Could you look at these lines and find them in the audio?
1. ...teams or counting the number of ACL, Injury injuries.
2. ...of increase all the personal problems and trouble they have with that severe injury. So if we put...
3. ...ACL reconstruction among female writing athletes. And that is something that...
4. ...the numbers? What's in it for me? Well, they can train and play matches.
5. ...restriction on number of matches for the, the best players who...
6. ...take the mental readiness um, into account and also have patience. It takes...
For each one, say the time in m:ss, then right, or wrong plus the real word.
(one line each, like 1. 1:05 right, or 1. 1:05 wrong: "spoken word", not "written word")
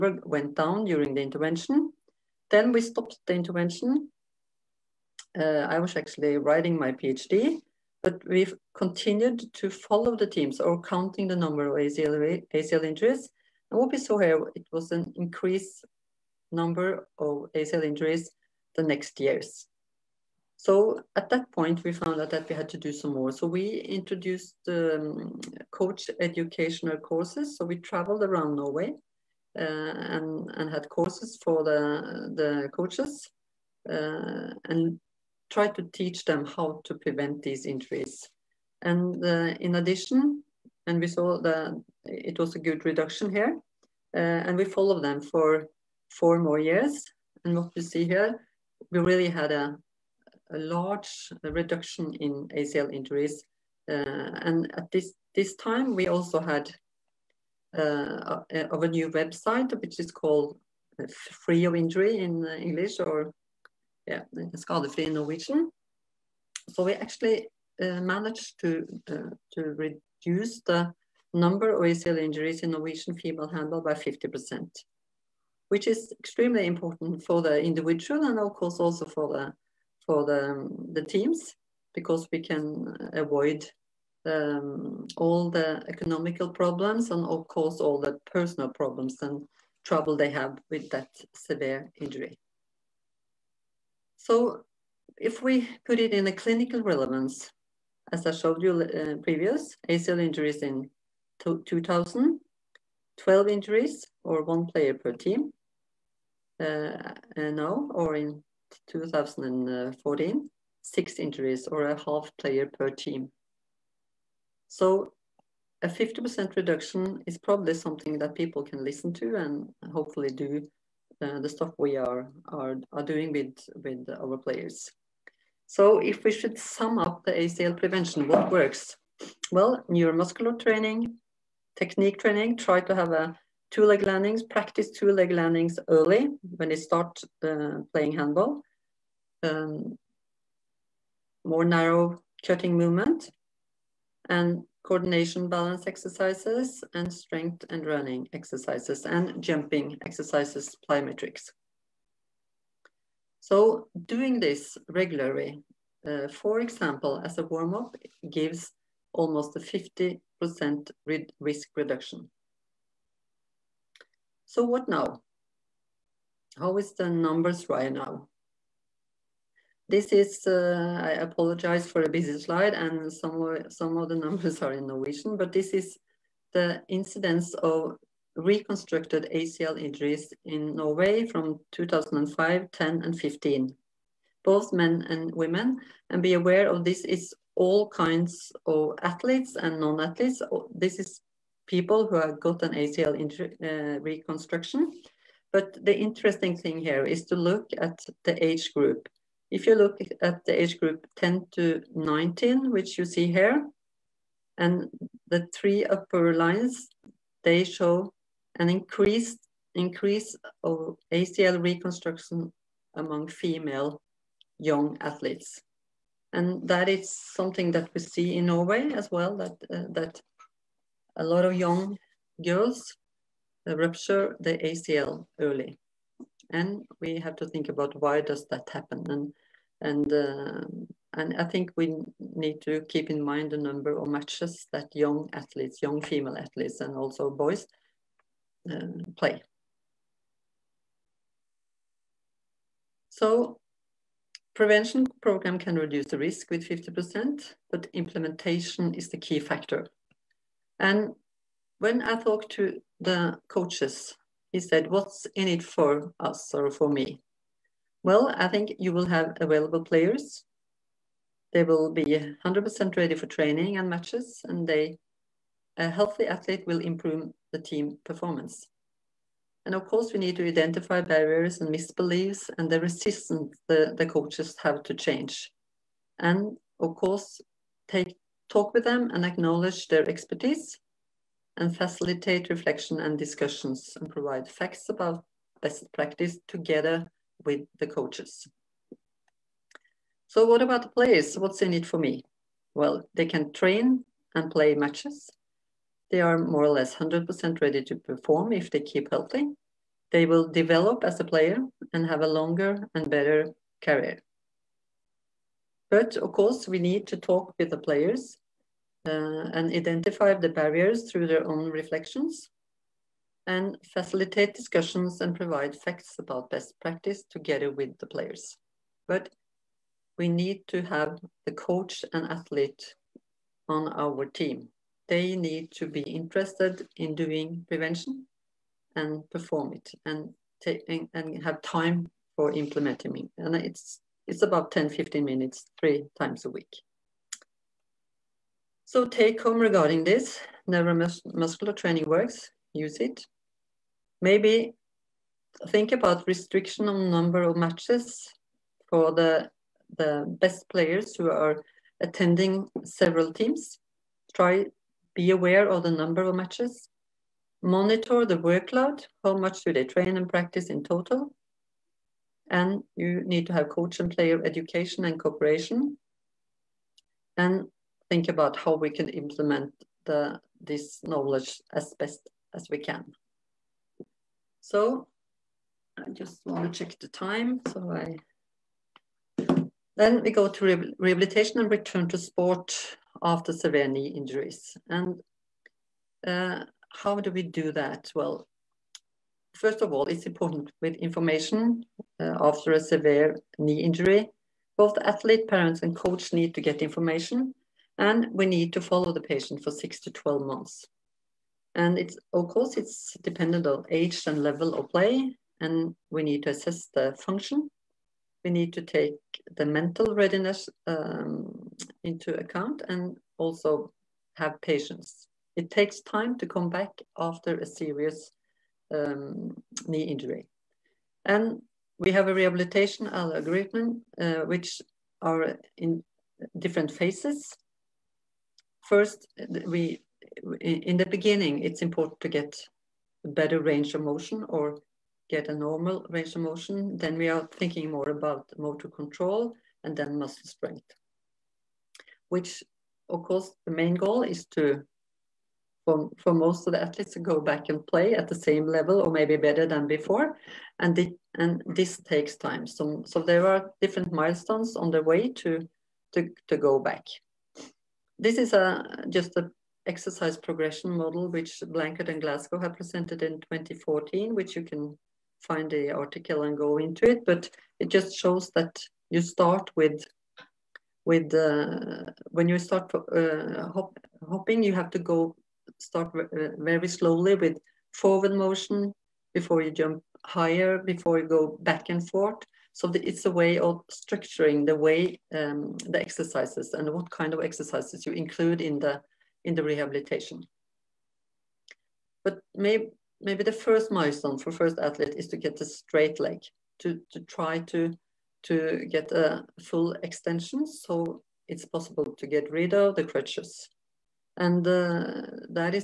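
1. 0:10 wrong: "ACL", not "Injury"
2. 1:27 wrong: "course", not "increase"
3. 3:31 wrong: "young", not "writing"
4. 4:50 wrong: "players", not "numbers"
5. 5:46 right
6. 6:48 right.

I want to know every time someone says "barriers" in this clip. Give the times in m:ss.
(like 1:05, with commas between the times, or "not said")
4:31, 5:10.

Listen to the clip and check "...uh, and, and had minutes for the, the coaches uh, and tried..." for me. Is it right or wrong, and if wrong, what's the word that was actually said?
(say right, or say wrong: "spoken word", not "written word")
wrong: "courses", not "minutes".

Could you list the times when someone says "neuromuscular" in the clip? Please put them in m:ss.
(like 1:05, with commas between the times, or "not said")
2:09, 5:40.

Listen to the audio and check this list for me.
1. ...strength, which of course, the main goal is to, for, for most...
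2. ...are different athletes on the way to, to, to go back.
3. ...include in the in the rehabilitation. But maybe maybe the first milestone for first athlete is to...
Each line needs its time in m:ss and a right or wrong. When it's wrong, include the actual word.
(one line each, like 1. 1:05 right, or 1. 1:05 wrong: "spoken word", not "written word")
1. 7:20 right
2. 7:33 wrong: "milestones", not "athletes"
3. 8:08 right.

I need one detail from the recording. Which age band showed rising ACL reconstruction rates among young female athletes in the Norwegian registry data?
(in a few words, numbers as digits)
10 to 19.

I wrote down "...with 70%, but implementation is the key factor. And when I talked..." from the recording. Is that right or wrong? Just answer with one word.
wrong.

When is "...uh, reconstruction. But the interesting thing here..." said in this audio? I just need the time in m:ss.
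3:13.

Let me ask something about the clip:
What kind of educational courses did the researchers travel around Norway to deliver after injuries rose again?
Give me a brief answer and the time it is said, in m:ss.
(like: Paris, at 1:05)
Coach educational courses, at 0:25.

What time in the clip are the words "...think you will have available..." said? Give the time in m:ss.
4:18.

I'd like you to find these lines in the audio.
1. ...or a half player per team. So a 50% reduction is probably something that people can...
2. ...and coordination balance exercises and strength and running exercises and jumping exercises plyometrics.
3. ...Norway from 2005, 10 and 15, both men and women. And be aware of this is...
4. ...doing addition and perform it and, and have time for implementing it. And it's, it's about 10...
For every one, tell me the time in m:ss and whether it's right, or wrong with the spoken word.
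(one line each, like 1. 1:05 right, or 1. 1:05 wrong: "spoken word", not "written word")
1. 1:51 right
2. 2:24 right
3. 3:00 right
4. 5:27 wrong: "prevention", not "addition".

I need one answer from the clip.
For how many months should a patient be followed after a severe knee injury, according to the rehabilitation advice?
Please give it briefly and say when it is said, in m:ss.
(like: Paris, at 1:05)
6 to 12 months, at 6:39.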